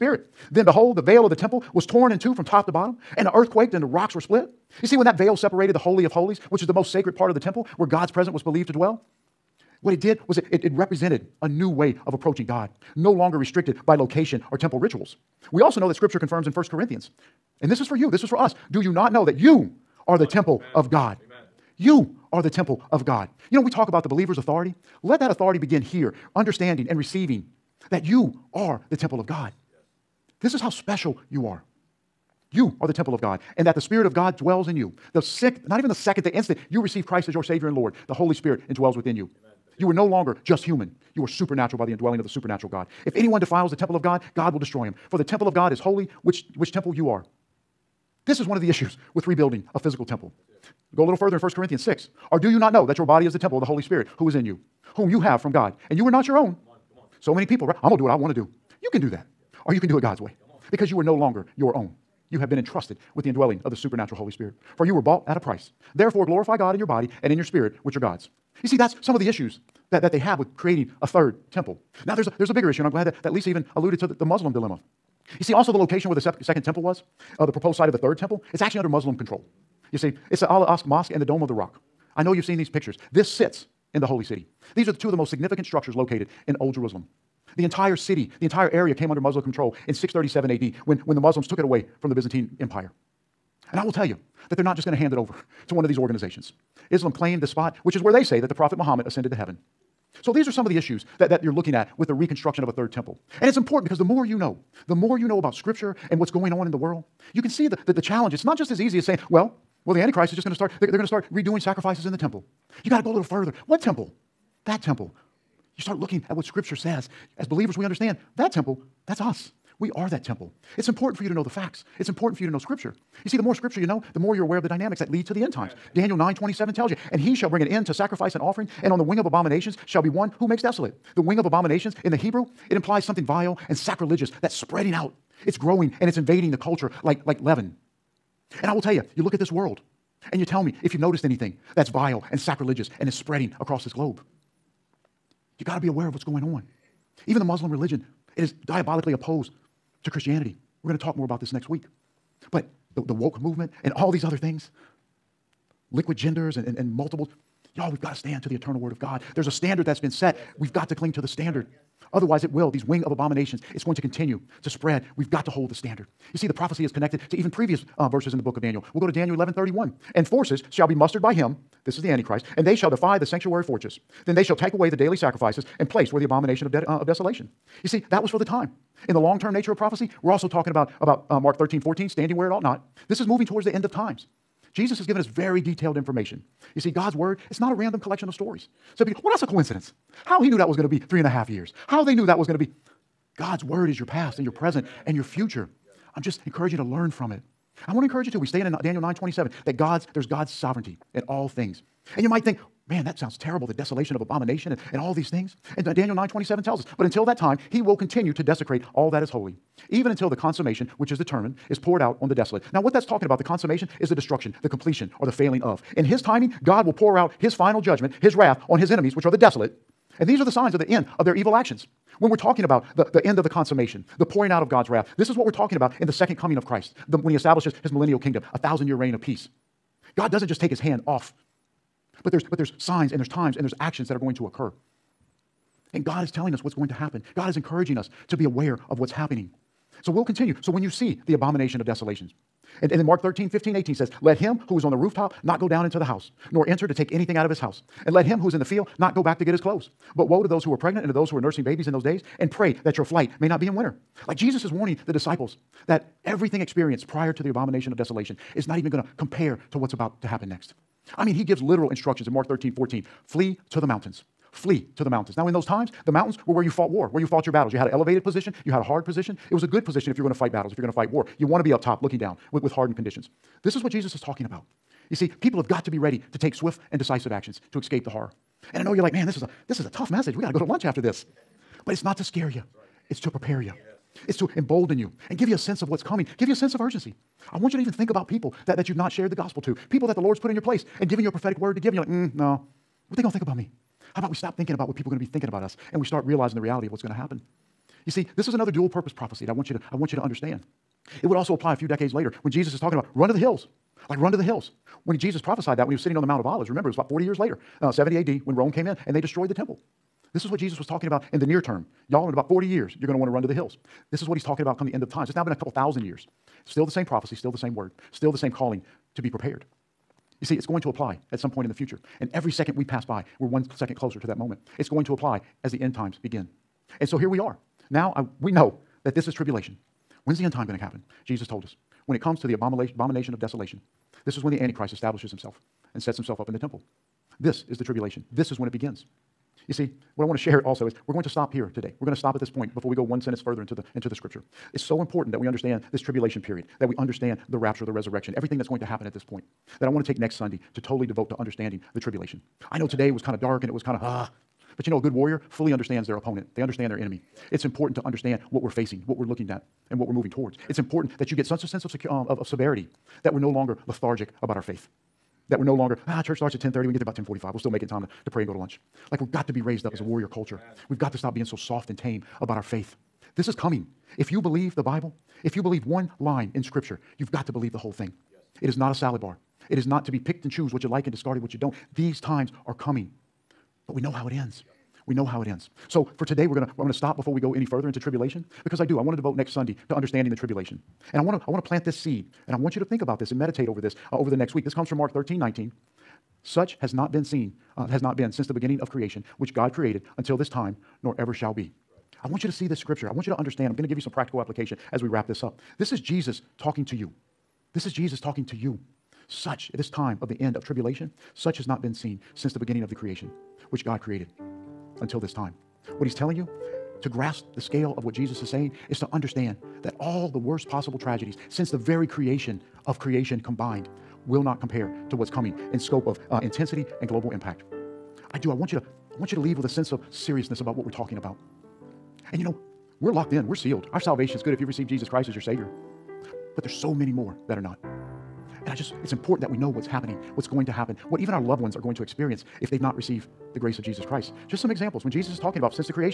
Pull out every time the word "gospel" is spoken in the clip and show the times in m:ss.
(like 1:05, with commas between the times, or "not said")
4:49.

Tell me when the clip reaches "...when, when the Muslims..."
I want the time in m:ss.
1:30.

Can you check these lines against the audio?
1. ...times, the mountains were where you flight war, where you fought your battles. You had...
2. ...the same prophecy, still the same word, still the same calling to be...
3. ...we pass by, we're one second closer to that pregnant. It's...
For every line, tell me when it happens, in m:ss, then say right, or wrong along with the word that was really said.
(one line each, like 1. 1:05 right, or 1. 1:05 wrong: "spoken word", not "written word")
1. 4:25 wrong: "fought", not "flight"
2. 5:16 right
3. 5:22 wrong: "moment", not "pregnant".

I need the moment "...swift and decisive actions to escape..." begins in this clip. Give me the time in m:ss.
4:36.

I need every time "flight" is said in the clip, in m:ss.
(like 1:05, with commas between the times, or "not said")
4:13.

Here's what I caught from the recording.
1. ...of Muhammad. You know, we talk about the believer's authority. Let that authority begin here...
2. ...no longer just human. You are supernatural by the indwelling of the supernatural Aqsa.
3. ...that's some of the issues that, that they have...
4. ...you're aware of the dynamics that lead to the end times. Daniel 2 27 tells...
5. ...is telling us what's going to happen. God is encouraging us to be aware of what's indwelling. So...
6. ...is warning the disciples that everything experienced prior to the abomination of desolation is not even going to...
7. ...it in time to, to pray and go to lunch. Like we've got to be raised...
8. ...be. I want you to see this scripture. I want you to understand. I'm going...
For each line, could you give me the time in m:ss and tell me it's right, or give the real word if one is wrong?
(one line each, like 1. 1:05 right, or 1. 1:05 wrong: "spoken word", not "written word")
1. 0:22 wrong: "God", not "Muhammad"
2. 0:39 wrong: "God", not "Aqsa"
3. 1:08 right
4. 2:04 wrong: "9", not "2"
5. 3:56 wrong: "happening", not "indwelling"
6. 4:14 right
7. 6:07 right
8. 6:41 right.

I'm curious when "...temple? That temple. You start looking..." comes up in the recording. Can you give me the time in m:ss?
1:53.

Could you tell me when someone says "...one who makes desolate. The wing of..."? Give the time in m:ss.
2:10.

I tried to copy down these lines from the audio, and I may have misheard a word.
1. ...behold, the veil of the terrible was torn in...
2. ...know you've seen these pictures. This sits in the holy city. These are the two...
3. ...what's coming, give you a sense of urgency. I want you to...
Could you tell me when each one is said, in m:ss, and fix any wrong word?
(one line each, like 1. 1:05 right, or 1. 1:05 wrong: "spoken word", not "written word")
1. 0:00 wrong: "temple", not "terrible"
2. 1:22 right
3. 4:45 right.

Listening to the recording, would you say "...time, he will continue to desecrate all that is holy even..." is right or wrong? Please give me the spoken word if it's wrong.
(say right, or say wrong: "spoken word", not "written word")
right.